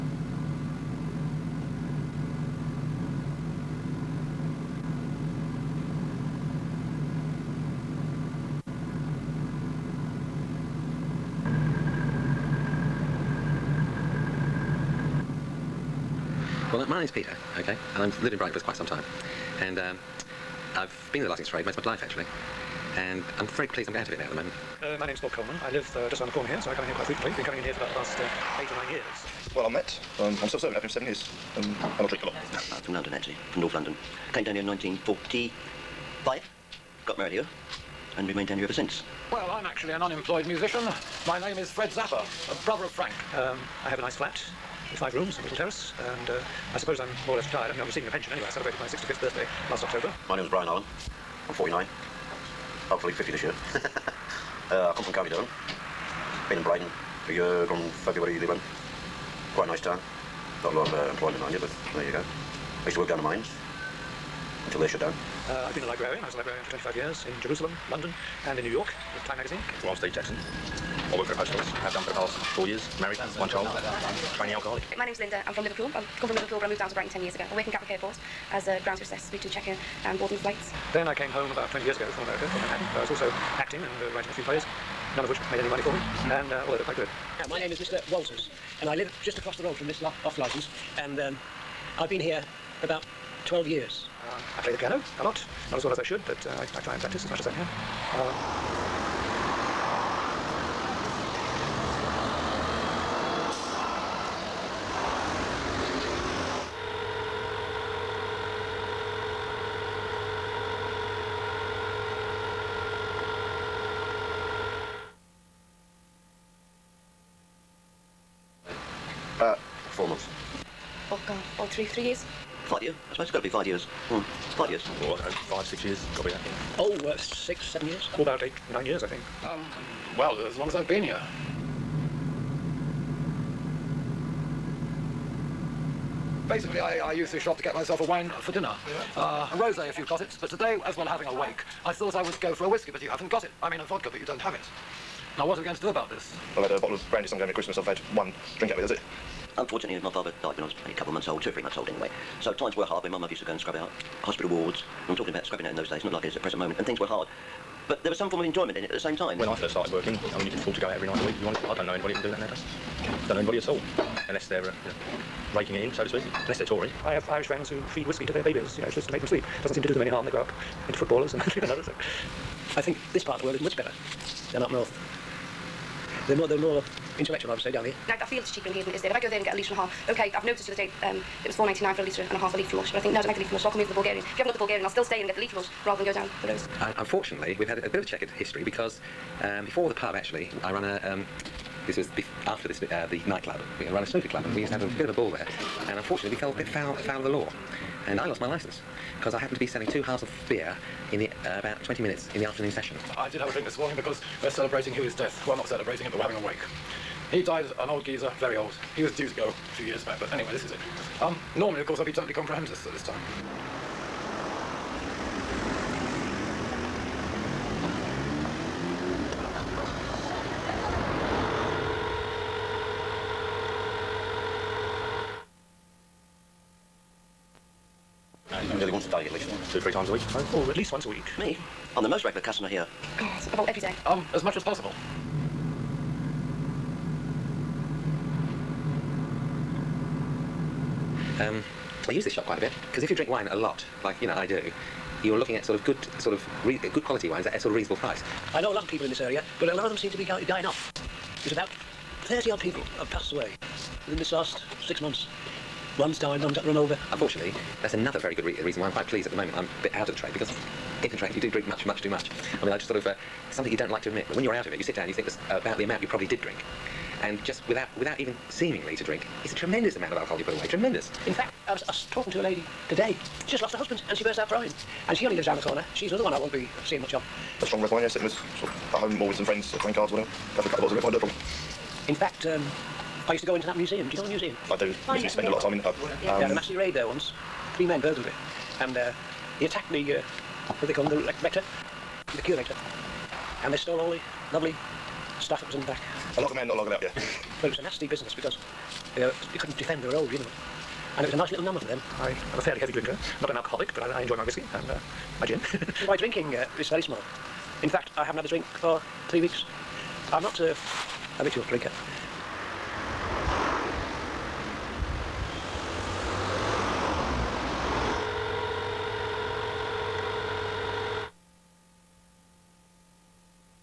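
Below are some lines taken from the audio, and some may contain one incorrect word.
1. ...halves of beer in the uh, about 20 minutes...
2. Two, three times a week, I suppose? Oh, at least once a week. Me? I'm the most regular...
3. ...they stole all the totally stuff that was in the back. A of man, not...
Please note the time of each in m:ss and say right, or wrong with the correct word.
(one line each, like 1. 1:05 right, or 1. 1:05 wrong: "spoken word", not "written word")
1. 3:20 right
2. 3:49 right
3. 4:53 wrong: "lovely", not "totally".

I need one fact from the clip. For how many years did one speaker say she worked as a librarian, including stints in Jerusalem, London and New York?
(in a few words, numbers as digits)
25.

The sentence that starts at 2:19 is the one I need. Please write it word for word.
Uh, a rosé, if you've got it.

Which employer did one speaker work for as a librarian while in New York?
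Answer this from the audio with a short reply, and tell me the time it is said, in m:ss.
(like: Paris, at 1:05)
Time magazine, at 1:09.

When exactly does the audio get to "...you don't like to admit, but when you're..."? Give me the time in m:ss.
4:23.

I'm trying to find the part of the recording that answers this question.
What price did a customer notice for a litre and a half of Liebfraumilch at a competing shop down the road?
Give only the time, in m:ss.
3:01.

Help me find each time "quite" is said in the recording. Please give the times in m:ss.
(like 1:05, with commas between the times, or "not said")
0:18, 0:26, 0:59, 1:26, 4:02, 4:18.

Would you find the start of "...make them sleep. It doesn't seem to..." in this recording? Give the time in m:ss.
2:49.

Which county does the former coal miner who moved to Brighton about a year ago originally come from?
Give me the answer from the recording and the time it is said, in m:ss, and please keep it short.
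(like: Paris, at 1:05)
County Durham, at 0:55.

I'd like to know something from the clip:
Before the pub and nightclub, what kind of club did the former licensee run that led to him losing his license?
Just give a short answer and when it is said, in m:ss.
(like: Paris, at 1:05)
snooker club, at 3:14.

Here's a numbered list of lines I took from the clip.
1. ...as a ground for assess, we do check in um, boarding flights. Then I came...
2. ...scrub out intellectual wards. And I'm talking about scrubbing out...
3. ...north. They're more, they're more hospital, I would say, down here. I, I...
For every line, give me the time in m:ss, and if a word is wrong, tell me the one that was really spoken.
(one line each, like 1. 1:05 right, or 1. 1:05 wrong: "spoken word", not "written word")
1. 1:18 right
2. 2:33 wrong: "hospital", not "intellectual"
3. 2:54 wrong: "intellectual", not "hospital".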